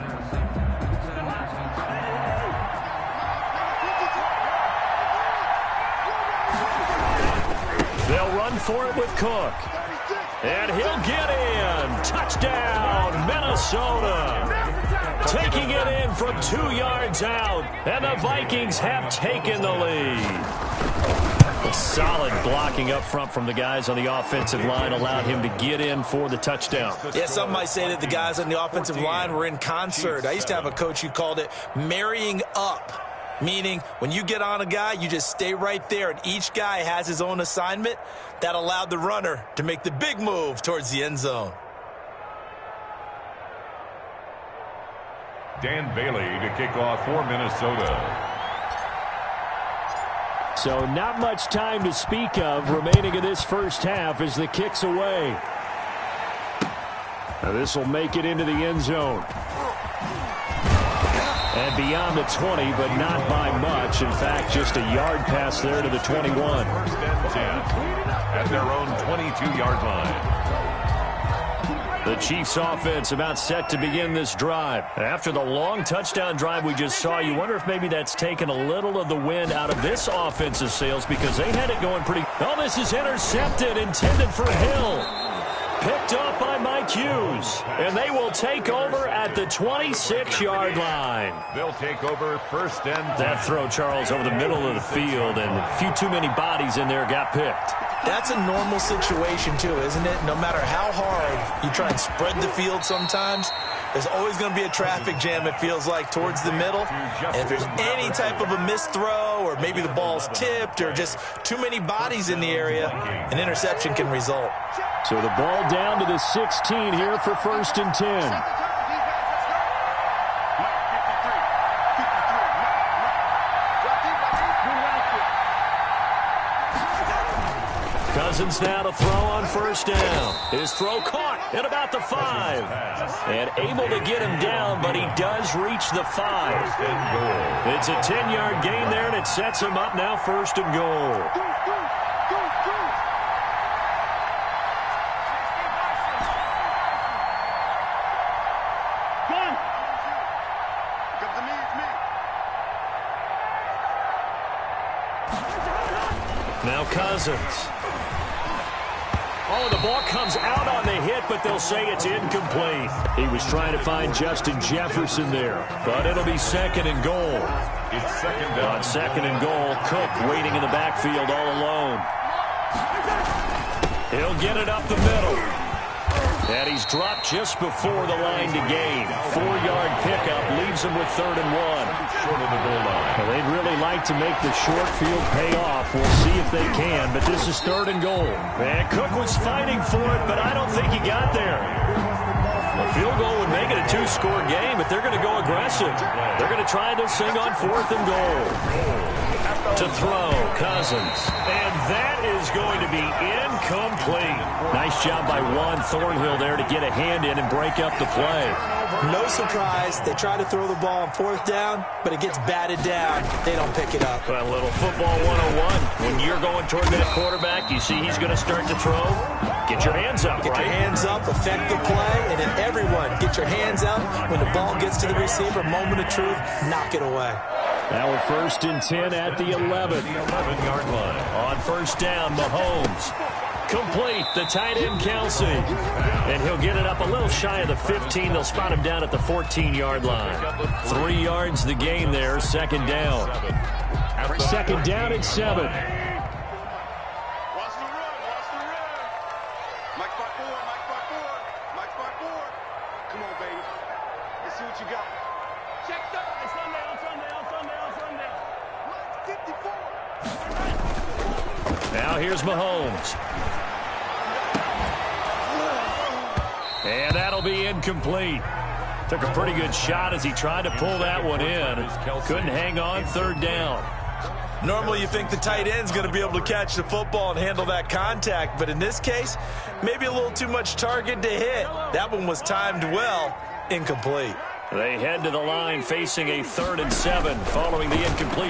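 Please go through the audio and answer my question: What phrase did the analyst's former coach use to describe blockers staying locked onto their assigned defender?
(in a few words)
Marrying up.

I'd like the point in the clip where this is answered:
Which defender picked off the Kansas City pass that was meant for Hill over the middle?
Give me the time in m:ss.
1:26.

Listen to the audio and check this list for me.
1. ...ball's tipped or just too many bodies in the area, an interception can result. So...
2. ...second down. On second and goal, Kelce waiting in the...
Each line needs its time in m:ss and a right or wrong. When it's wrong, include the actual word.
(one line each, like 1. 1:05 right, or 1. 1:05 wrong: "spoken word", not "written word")
1. 1:49 right
2. 2:48 wrong: "Cook", not "Kelce".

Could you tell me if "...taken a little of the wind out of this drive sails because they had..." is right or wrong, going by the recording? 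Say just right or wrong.
wrong.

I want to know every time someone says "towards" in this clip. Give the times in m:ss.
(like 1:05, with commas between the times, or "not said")
0:40, 1:46, 3:36.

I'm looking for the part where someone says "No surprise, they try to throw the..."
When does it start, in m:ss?
3:29.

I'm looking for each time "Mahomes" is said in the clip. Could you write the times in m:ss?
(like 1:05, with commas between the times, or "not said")
3:52, 4:22.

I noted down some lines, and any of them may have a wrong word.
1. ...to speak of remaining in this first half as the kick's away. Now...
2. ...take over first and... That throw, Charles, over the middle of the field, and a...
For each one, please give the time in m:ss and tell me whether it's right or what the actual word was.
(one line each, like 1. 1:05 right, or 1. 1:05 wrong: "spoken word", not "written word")
1. 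0:51 right
2. 1:31 right.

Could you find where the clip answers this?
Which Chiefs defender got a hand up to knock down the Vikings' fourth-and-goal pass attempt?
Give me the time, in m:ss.
3:25.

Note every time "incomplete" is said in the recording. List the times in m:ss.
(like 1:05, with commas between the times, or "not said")
2:42, 3:23, 4:27, 4:43.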